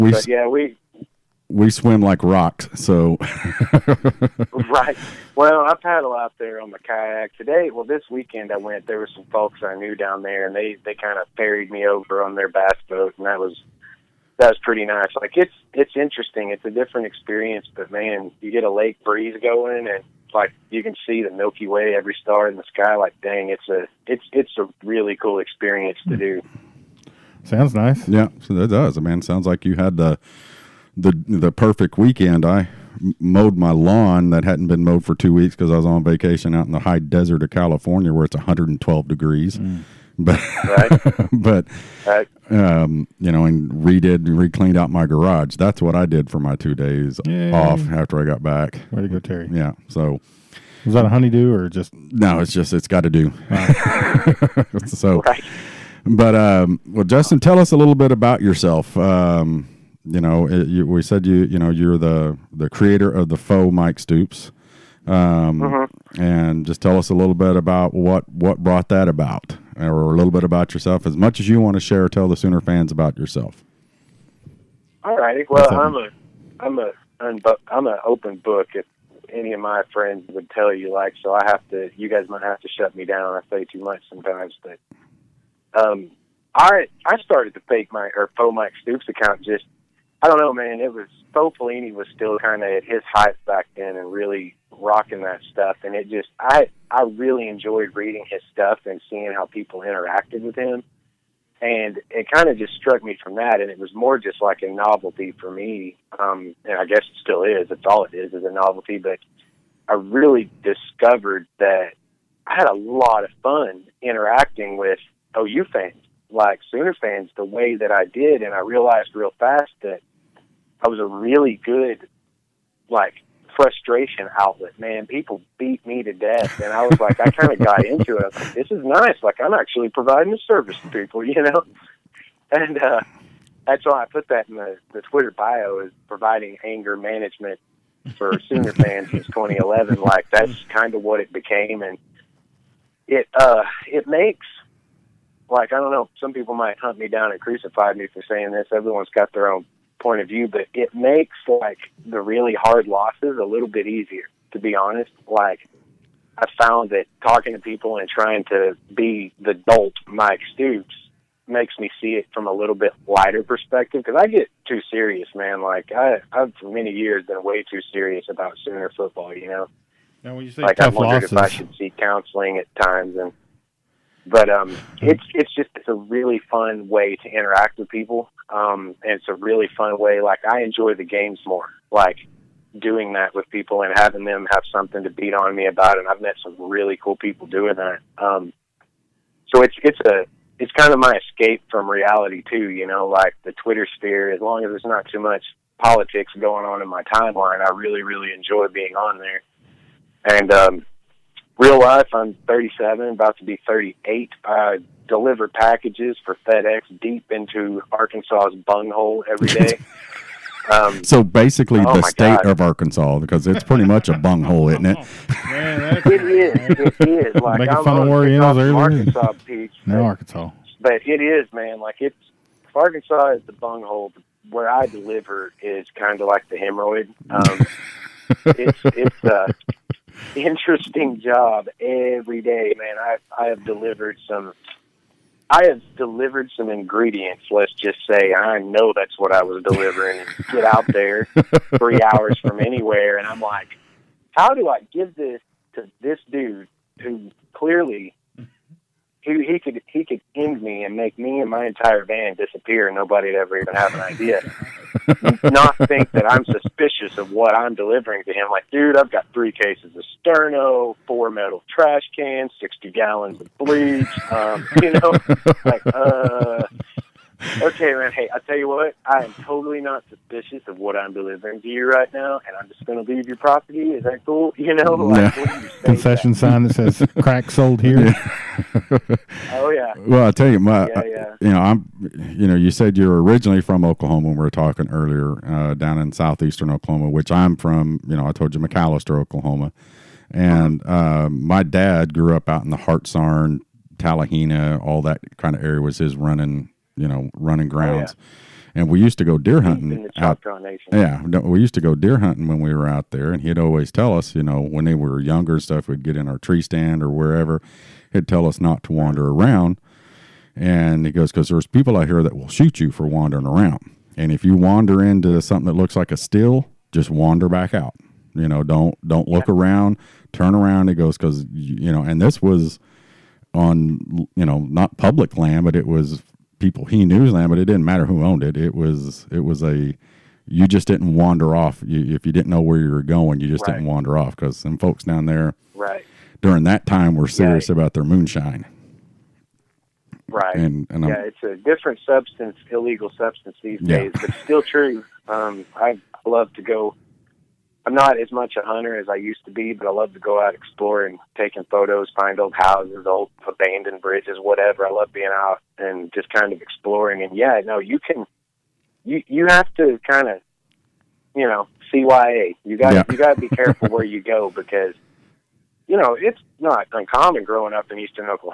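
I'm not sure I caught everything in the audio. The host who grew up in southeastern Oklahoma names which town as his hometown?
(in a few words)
McAlester, Oklahoma.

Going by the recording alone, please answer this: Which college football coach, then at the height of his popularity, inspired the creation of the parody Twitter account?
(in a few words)
Bo Pelini.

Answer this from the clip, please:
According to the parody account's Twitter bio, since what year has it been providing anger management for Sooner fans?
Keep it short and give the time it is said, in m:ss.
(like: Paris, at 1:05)
2011, at 2:19.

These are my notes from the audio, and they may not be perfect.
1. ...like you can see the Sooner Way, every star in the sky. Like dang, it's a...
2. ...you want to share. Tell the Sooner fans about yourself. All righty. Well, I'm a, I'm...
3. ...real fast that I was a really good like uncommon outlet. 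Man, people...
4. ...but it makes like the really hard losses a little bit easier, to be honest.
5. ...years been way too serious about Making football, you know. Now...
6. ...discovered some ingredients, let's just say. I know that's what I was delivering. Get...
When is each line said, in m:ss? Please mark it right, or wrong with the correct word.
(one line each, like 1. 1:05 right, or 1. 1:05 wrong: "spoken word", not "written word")
1. 0:20 wrong: "Milky", not "Sooner"
2. 1:11 right
3. 1:59 wrong: "frustration", not "uncommon"
4. 2:30 right
5. 2:46 wrong: "Sooner", not "Making"
6. 3:55 wrong: "delivered", not "discovered".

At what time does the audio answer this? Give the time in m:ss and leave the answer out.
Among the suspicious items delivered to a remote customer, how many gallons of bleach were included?
4:22.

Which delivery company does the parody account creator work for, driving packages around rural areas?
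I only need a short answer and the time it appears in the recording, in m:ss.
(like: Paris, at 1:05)
FedEx, at 3:26.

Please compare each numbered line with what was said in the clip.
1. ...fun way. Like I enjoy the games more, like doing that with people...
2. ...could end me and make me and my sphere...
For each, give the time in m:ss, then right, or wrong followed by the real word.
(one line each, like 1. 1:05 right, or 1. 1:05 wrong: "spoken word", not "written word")
1. 2:59 right
2. 4:10 wrong: "entire", not "sphere".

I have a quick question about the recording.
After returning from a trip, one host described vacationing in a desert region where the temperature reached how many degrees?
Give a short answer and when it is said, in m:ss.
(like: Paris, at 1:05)
112, at 0:38.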